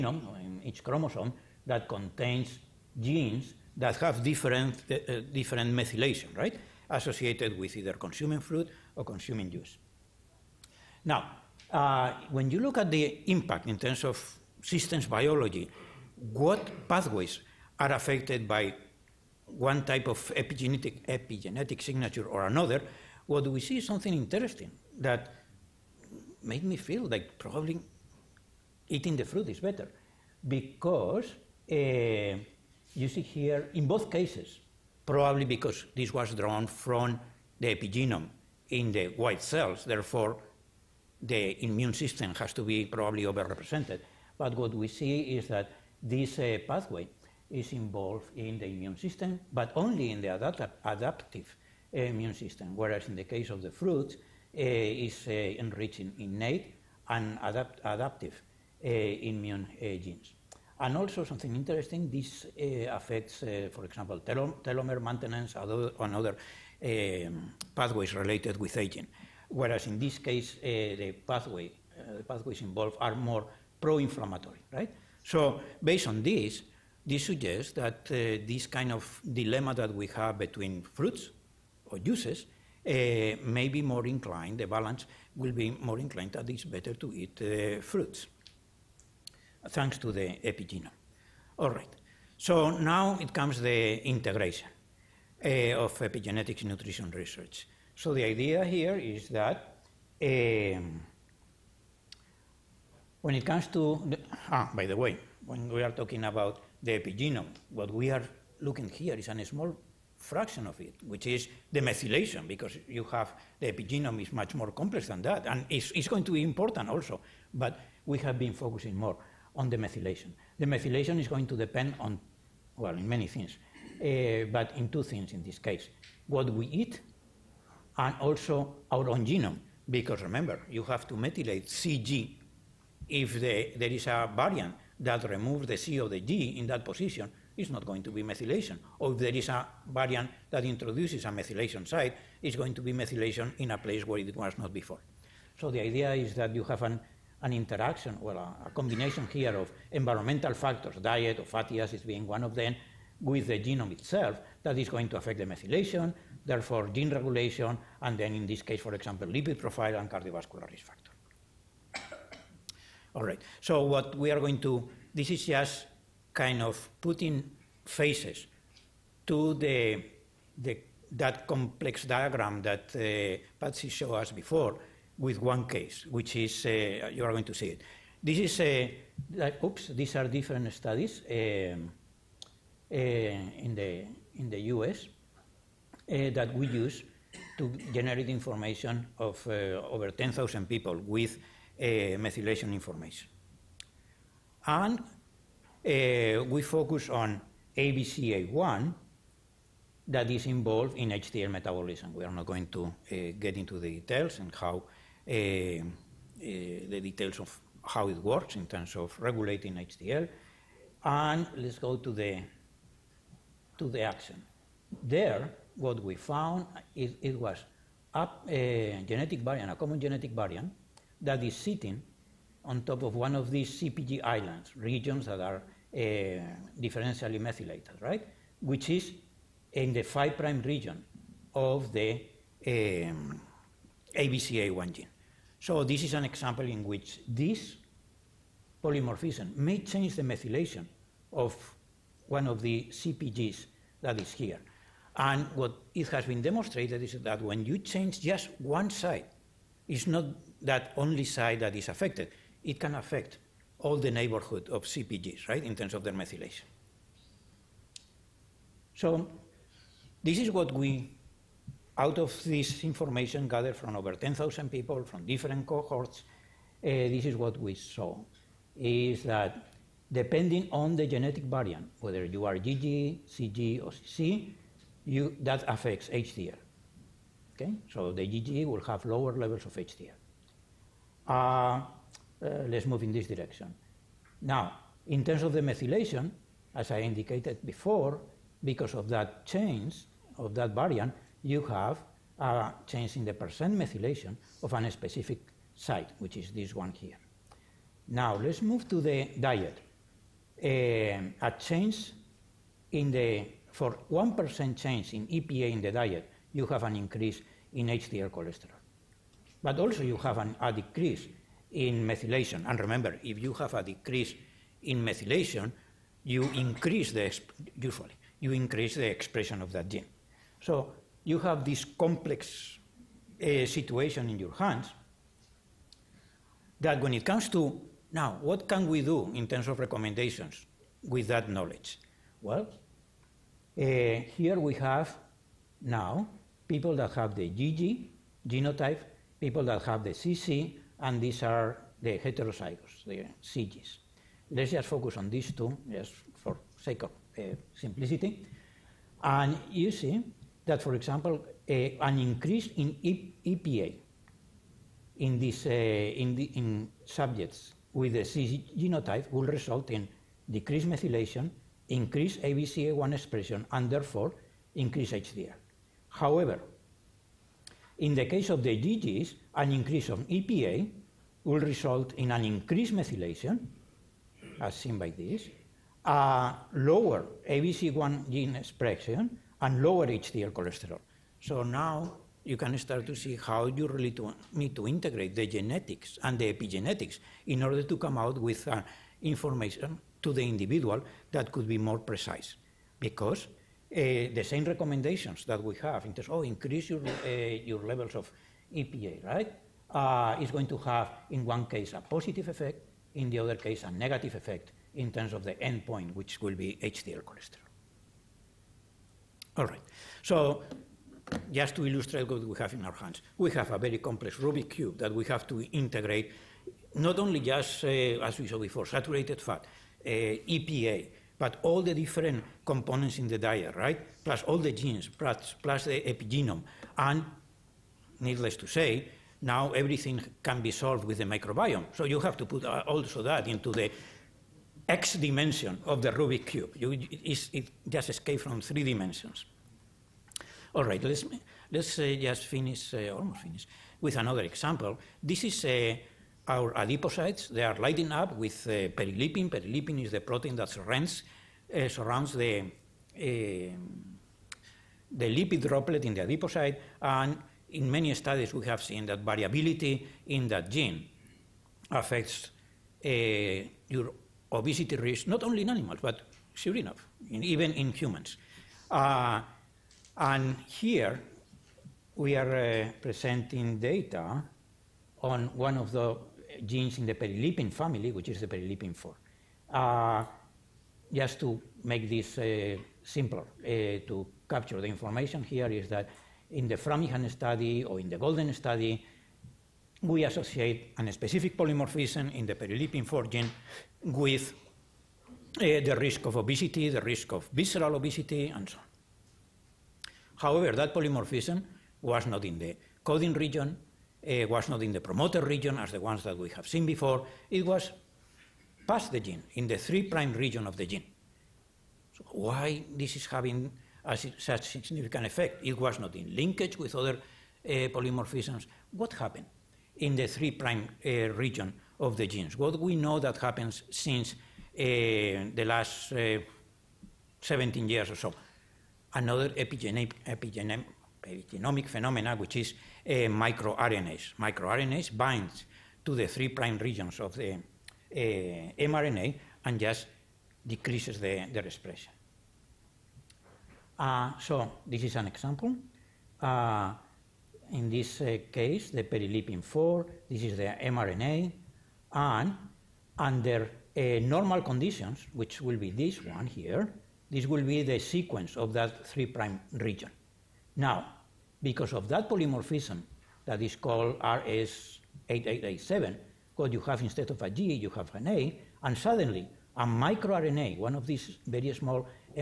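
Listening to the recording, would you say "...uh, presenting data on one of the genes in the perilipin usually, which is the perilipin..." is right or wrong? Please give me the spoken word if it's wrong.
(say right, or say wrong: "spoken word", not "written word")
wrong: "family", not "usually".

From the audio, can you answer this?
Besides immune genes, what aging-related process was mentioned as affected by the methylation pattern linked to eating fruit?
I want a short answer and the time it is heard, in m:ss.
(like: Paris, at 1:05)
Telomere maintenance, at 1:04.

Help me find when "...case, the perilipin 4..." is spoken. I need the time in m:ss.
9:08.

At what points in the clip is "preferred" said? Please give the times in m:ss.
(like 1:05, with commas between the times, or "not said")
not said.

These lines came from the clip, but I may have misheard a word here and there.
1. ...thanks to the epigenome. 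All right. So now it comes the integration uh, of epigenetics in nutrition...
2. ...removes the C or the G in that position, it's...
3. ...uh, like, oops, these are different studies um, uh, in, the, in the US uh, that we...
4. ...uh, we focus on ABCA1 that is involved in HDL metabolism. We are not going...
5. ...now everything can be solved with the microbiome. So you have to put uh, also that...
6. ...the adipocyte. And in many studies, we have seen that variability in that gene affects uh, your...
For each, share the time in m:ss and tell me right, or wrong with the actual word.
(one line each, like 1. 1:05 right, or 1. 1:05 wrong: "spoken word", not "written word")
1. 1:29 right
2. 2:15 right
3. 2:58 right
4. 3:15 right
5. 7:09 right
6. 7:36 right.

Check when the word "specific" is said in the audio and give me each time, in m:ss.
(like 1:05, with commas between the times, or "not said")
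4:54, 8:11.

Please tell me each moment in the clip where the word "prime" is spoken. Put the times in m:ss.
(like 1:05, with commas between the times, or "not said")
8:30, 8:40, 8:56, 9:19.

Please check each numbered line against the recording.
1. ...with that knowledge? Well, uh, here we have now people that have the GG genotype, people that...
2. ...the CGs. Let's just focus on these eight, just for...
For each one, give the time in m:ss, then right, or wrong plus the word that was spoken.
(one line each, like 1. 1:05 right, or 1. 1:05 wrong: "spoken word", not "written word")
1. 5:31 right
2. 5:43 wrong: "two", not "eight".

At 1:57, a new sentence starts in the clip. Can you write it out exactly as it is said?
But we have been focusing more on the methylation.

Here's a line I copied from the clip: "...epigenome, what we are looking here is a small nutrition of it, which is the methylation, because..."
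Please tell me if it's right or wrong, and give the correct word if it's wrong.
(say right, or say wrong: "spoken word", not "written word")
wrong: "fraction", not "nutrition".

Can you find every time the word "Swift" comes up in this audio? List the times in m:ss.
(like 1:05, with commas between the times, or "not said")
not said.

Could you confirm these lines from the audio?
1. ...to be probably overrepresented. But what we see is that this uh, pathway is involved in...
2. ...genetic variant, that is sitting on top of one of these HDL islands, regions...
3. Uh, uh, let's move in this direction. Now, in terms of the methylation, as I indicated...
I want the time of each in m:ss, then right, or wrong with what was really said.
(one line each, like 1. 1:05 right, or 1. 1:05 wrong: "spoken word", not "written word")
1. 0:42 right
2. 3:39 wrong: "CPG", not "HDL"
3. 4:41 right.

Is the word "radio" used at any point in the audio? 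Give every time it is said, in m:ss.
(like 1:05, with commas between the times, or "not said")
not said.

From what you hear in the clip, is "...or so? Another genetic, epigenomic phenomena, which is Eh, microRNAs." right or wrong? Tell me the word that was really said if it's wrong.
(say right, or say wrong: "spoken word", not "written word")
wrong: "epigenomic", not "genetic".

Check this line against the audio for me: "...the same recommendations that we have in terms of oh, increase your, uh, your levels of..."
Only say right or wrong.
right.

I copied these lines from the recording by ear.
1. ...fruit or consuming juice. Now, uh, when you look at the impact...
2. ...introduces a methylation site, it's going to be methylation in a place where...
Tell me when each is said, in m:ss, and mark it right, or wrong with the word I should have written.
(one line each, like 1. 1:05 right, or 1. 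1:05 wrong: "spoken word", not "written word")
1. 0:08 right
2. 2:20 right.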